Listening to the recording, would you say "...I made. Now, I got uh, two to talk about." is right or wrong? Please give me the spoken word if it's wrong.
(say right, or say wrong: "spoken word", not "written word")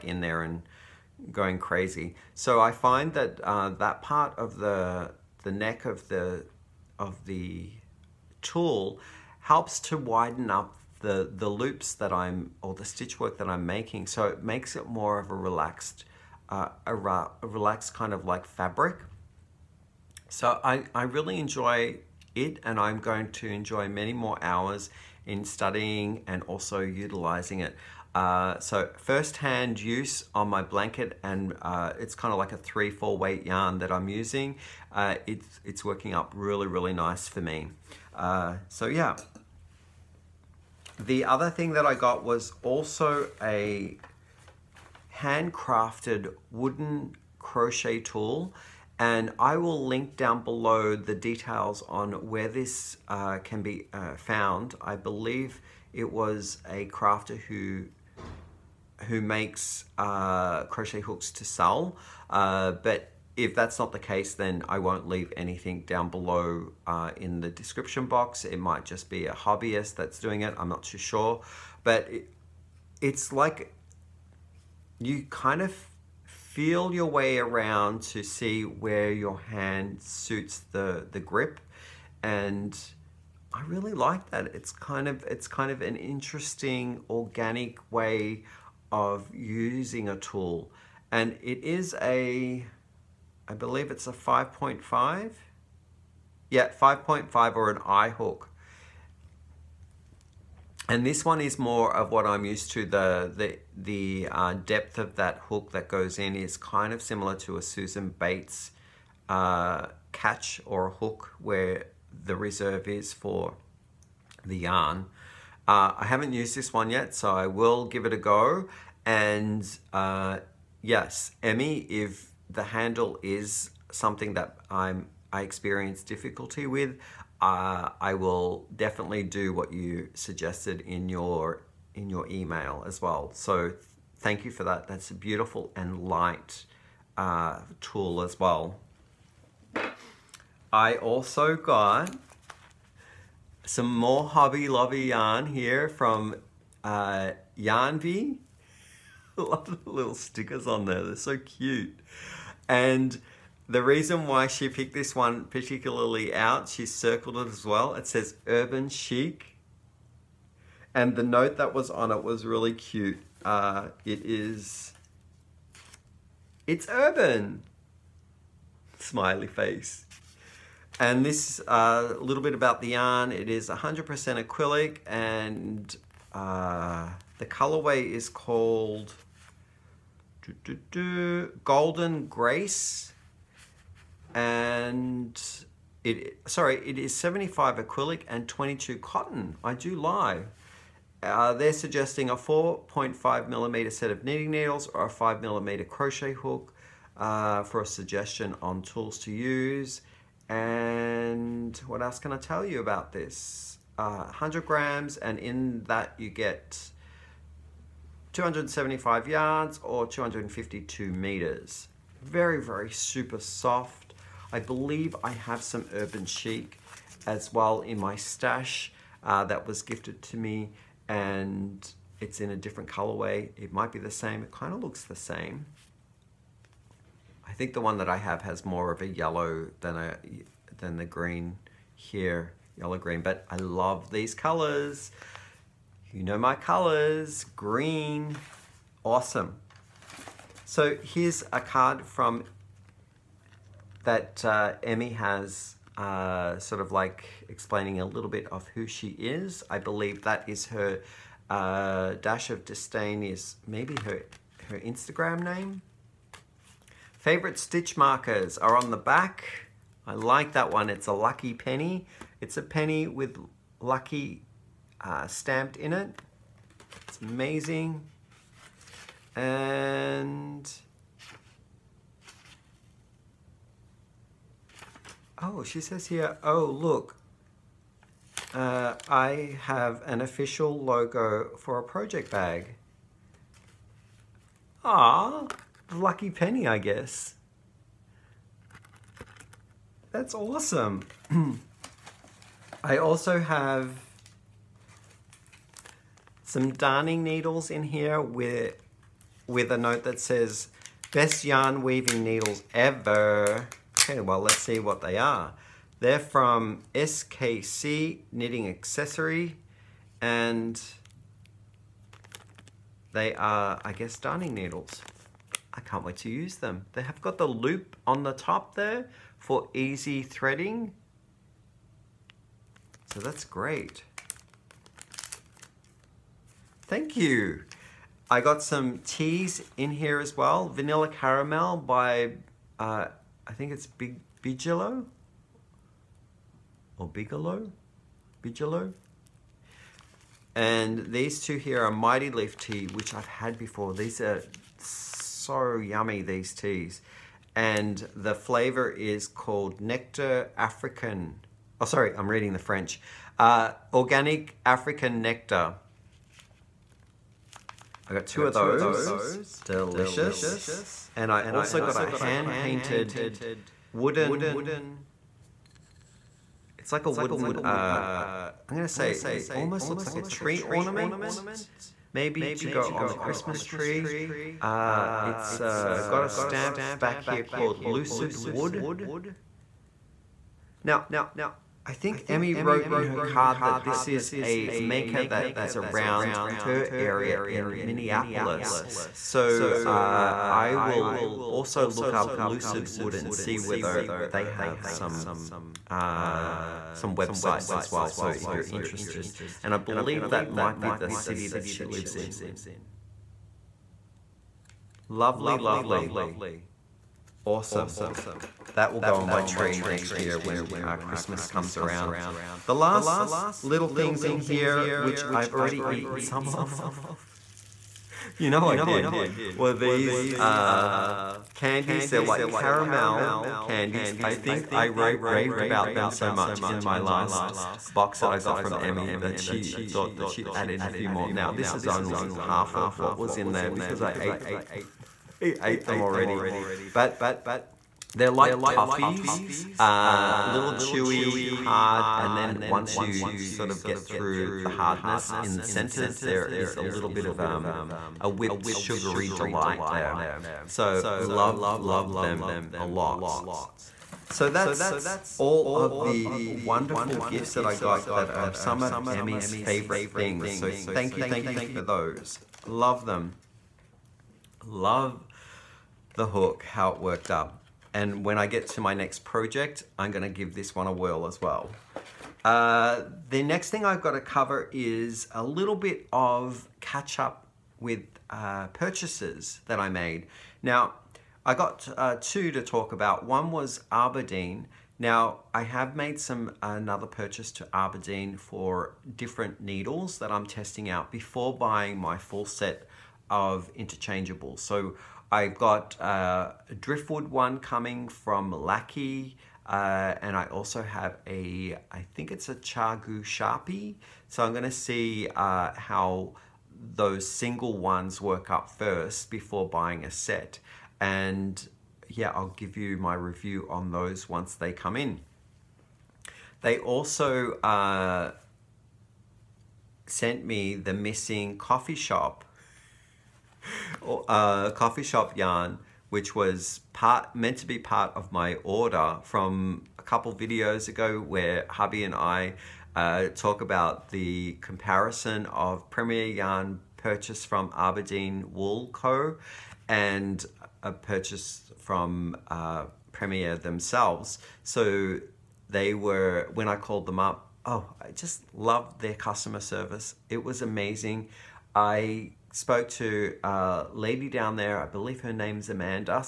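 right.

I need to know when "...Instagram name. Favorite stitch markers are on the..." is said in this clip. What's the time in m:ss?
4:14.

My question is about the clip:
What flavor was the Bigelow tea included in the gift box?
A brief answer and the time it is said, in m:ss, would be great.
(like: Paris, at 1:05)
Vanilla Caramel, at 5:30.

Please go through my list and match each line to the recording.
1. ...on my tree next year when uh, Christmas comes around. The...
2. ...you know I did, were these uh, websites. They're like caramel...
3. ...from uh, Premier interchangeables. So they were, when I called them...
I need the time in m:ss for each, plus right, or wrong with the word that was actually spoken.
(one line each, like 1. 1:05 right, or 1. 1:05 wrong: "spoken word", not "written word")
1. 6:49 right
2. 6:58 wrong: "candies", not "websites"
3. 9:01 wrong: "themselves", not "interchangeables".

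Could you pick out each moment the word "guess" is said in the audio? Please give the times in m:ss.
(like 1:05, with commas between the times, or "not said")
4:46, 5:13.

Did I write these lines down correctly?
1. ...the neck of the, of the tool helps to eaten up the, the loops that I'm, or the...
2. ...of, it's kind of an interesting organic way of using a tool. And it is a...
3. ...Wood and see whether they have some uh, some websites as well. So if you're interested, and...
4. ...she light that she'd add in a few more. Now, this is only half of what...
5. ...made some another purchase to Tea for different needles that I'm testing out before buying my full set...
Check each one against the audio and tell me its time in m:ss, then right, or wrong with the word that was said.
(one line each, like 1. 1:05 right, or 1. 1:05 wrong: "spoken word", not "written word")
1. 0:05 wrong: "widen", not "eaten"
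2. 1:25 right
3. 6:32 right
4. 7:09 wrong: "thought", not "light"
5. 8:05 wrong: "Aberdeen", not "Tea".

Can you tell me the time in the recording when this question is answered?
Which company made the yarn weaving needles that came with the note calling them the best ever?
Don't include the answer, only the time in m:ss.
5:06.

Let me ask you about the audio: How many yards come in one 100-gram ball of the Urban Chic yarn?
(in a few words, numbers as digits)
275.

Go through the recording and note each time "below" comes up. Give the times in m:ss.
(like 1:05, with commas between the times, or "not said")
0:50, 1:06.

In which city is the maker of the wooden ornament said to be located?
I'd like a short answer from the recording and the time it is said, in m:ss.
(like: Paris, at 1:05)
Minneapolis, at 6:27.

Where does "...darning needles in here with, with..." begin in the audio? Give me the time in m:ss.
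4:56.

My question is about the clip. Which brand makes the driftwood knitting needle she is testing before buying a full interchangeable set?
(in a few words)
Lykke.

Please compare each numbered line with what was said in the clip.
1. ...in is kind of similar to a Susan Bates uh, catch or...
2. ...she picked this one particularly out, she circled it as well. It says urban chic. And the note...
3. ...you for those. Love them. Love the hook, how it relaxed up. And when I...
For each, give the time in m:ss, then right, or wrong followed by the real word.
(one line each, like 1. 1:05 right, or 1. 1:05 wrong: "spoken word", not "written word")
1. 1:46 right
2. 2:34 right
3. 7:41 wrong: "worked", not "relaxed".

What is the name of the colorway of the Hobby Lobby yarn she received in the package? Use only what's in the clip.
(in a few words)
Golden Grace.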